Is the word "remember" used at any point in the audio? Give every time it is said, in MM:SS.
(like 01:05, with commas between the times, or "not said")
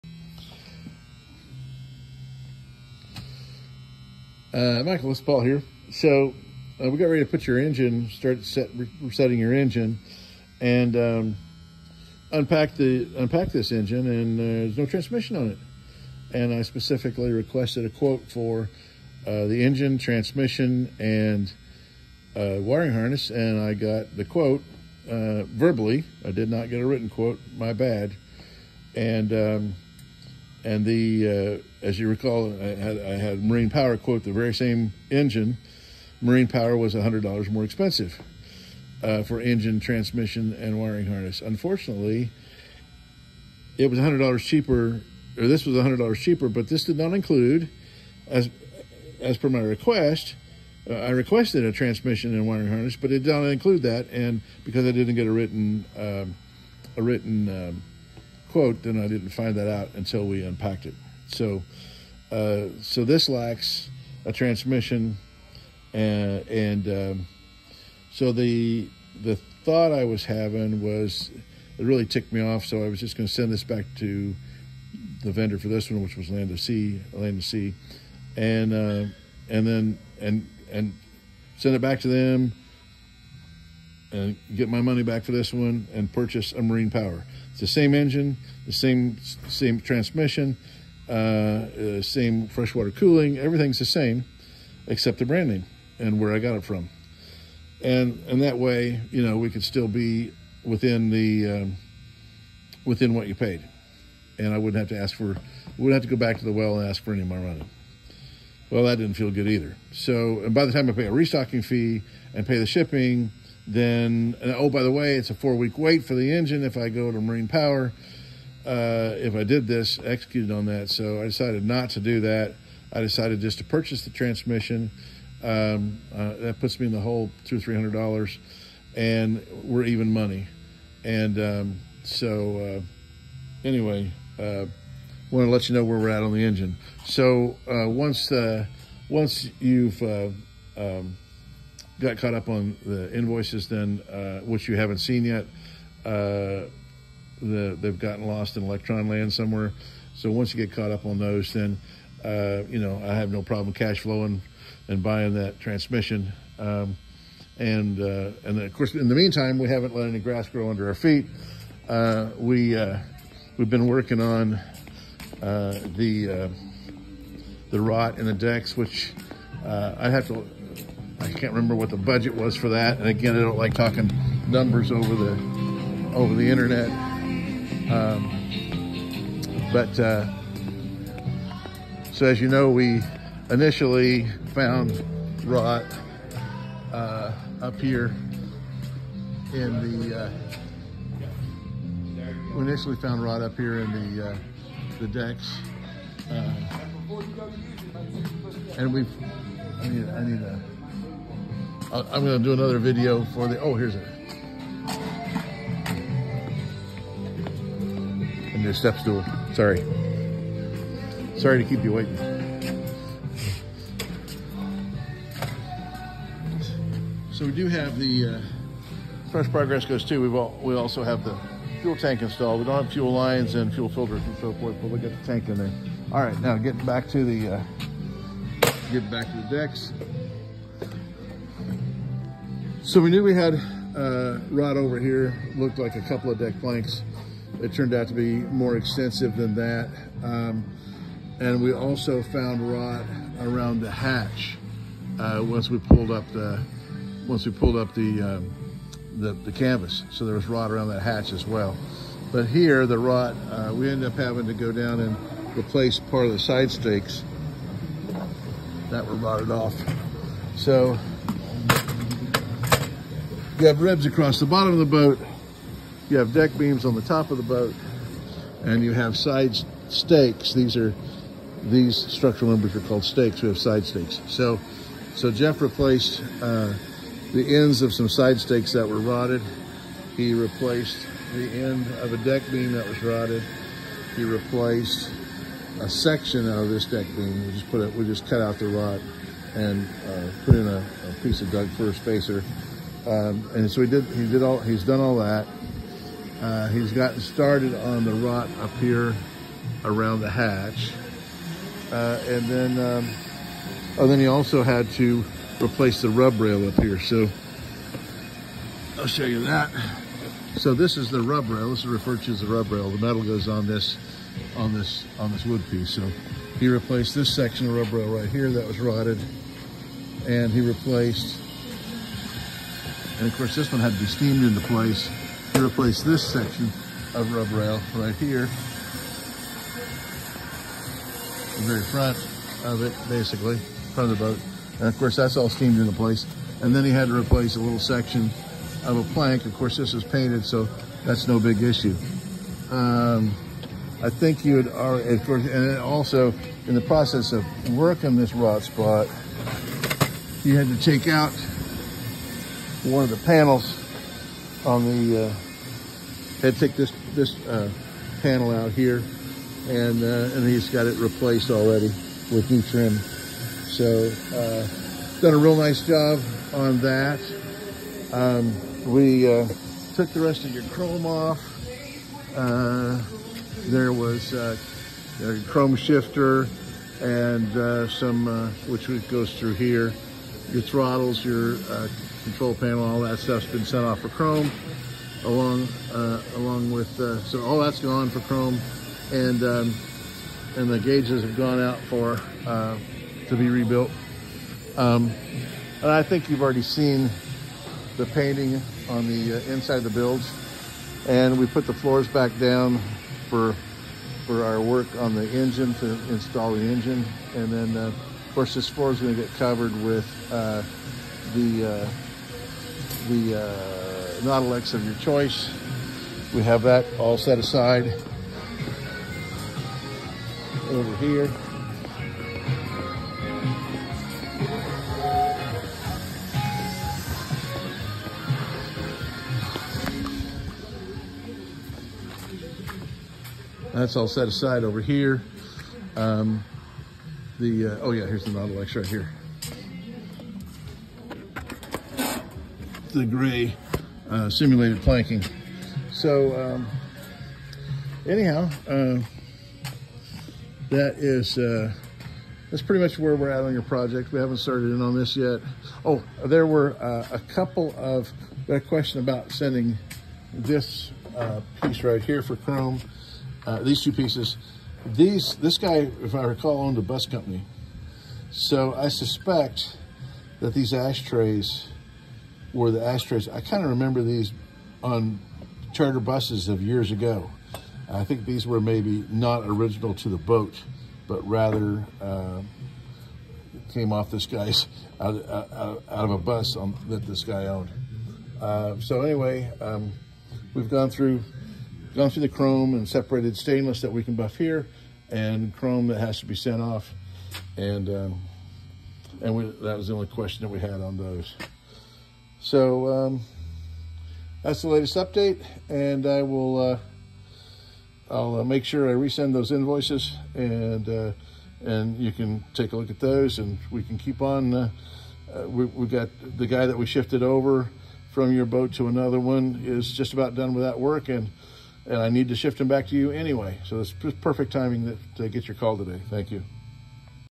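02:51, 07:53.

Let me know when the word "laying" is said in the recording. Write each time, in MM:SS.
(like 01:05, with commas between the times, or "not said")
not said.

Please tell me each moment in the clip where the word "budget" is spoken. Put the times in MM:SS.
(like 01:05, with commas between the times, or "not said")
02:51.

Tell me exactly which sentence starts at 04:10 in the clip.
So there was rot around that hatch as well.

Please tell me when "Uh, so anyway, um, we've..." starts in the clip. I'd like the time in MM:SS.
08:08.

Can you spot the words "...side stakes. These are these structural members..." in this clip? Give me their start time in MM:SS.
04:29.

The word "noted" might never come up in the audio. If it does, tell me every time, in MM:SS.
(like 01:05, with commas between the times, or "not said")
not said.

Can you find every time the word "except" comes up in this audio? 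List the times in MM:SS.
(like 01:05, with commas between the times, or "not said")
01:34.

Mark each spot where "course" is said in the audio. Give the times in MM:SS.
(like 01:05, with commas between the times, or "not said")
02:38, 05:23, 05:34, 05:39, 05:45, 06:48.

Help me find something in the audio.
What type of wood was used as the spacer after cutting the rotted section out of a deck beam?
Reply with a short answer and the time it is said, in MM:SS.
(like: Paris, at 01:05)
Doug fir, at 04:51.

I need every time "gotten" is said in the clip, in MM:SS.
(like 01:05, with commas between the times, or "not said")
02:27, 04:56.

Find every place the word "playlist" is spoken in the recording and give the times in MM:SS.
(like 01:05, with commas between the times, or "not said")
not said.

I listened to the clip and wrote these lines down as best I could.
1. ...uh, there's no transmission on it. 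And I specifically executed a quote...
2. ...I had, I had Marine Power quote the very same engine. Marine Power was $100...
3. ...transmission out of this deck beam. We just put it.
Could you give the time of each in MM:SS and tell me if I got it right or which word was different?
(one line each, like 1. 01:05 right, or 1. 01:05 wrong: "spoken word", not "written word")
1. 00:14 wrong: "requested", not "executed"
2. 00:32 right
3. 04:45 wrong: "section", not "transmission".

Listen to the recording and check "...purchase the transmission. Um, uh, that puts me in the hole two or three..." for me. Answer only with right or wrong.
right.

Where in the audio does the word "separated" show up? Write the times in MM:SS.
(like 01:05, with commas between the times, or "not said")
08:12.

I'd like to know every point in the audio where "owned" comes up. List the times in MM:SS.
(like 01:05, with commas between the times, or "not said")
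07:46, 08:07.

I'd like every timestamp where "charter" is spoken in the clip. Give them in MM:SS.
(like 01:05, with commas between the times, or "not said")
07:55.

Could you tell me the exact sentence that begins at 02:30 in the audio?
So once you get caught up on those, then uh, you know I have no problem cash flowing and buying that transmission.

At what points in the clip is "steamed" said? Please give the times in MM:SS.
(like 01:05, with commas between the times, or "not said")
05:24, 05:35.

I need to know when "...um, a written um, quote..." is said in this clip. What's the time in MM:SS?
00:55.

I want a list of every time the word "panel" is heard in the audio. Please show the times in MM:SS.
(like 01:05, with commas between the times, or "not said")
05:53, 05:58, 06:22.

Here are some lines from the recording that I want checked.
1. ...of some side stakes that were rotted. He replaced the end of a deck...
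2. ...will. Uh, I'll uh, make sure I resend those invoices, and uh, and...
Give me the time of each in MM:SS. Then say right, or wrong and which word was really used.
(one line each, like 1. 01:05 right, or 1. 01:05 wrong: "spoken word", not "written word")
1. 04:37 right
2. 08:26 right.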